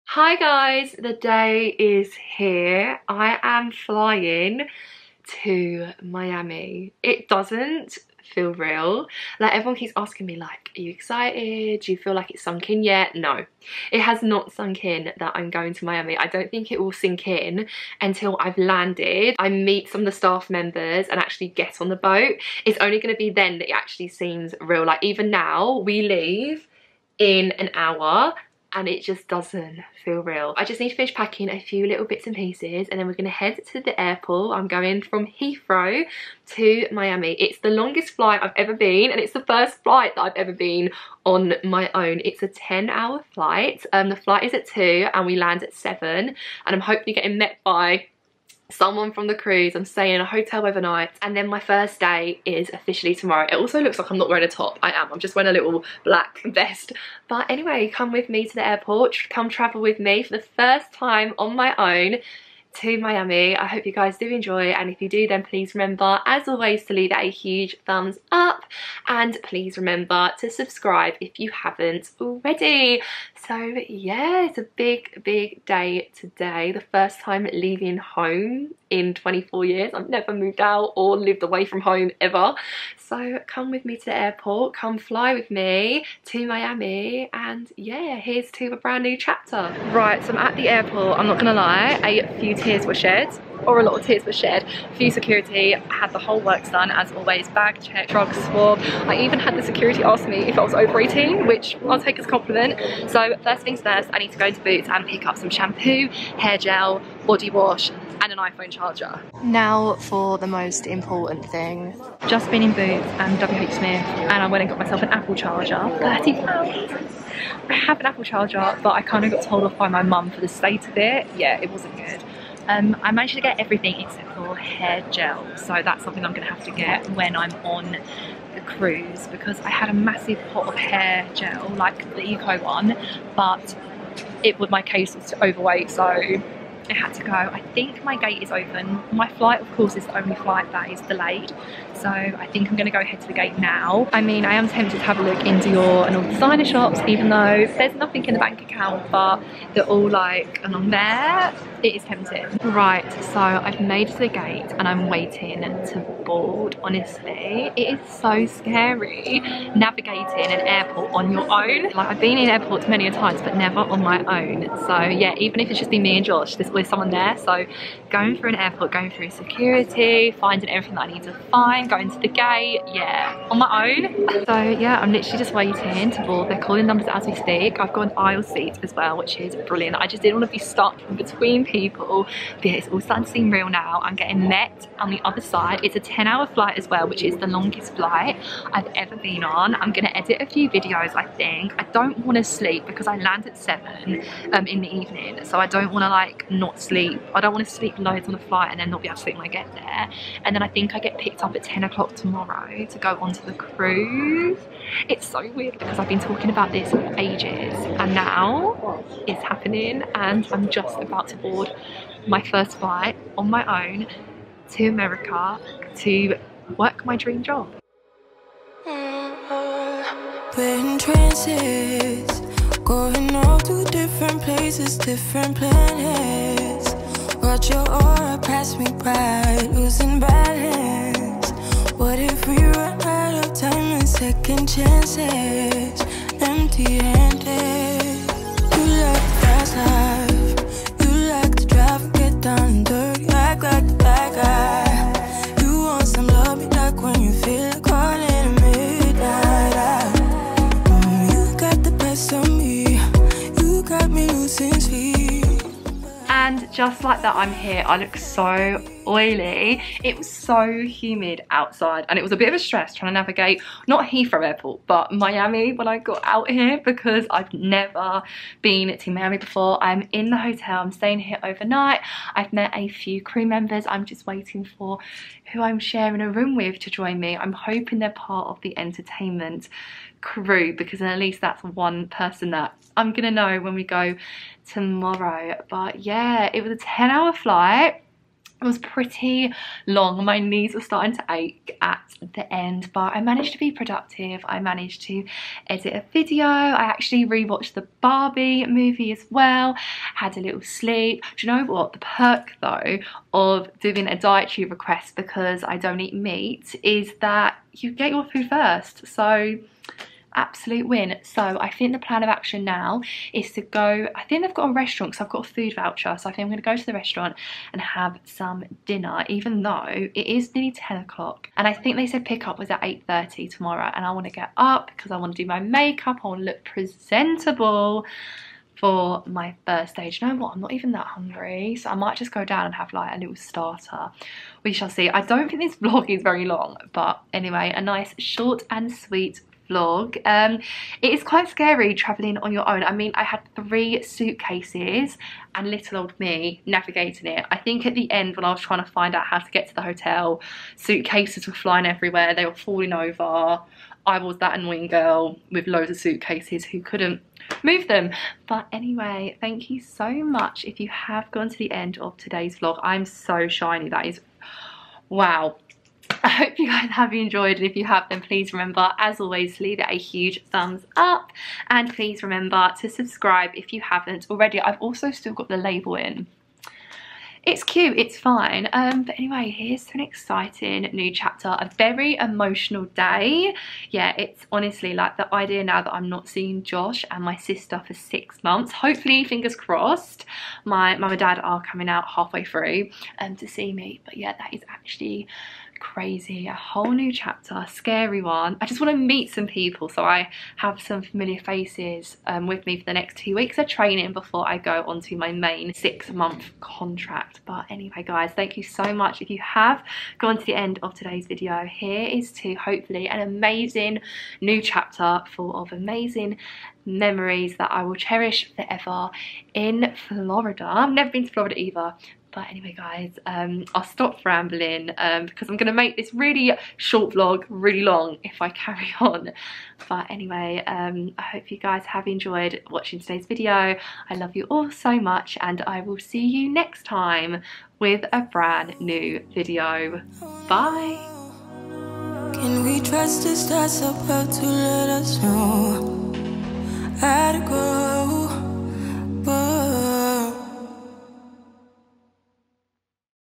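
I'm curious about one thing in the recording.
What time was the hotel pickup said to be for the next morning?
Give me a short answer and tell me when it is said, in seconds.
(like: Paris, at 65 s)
8:30, at 322 s.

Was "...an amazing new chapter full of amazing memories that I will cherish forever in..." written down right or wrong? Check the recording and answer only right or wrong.
right.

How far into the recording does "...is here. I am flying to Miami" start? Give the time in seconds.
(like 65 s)
1 s.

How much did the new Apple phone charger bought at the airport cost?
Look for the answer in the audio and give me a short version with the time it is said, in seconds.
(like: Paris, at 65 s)
£30, at 115 s.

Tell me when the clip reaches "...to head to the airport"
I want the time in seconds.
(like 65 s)
33 s.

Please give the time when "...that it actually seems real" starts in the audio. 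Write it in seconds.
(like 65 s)
23 s.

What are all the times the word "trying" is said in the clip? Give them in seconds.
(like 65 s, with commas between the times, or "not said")
262 s, 348 s.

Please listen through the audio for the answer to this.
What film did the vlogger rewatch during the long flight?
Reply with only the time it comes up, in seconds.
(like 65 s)
297 s.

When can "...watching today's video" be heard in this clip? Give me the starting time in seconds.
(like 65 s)
432 s.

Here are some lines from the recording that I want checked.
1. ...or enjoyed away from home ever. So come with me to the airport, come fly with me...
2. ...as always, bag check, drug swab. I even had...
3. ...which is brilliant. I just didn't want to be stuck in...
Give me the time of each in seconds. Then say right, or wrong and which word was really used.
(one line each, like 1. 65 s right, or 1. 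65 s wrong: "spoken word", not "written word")
1. 80 s wrong: "lived", not "enjoyed"
2. 96 s right
3. 179 s right.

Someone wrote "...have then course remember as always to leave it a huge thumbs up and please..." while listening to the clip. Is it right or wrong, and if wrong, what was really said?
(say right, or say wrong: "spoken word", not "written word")
wrong: "please", not "course".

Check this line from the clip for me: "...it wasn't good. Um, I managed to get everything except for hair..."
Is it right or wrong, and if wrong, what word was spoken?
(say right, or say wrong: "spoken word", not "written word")
right.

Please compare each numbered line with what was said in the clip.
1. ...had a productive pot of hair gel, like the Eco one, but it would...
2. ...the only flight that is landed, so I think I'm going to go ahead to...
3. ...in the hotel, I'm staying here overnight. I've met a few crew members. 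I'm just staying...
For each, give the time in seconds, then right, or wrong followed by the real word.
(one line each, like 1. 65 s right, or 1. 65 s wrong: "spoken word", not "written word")
1. 129 s wrong: "massive", not "productive"
2. 140 s wrong: "delayed", not "landed"
3. 270 s wrong: "waiting", not "staying".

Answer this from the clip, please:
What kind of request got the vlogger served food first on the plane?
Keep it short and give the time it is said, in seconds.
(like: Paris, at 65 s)
Dietary request, at 304 s.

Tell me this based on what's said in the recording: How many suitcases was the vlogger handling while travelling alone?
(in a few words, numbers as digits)
3.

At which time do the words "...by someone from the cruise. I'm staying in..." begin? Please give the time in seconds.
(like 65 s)
47 s.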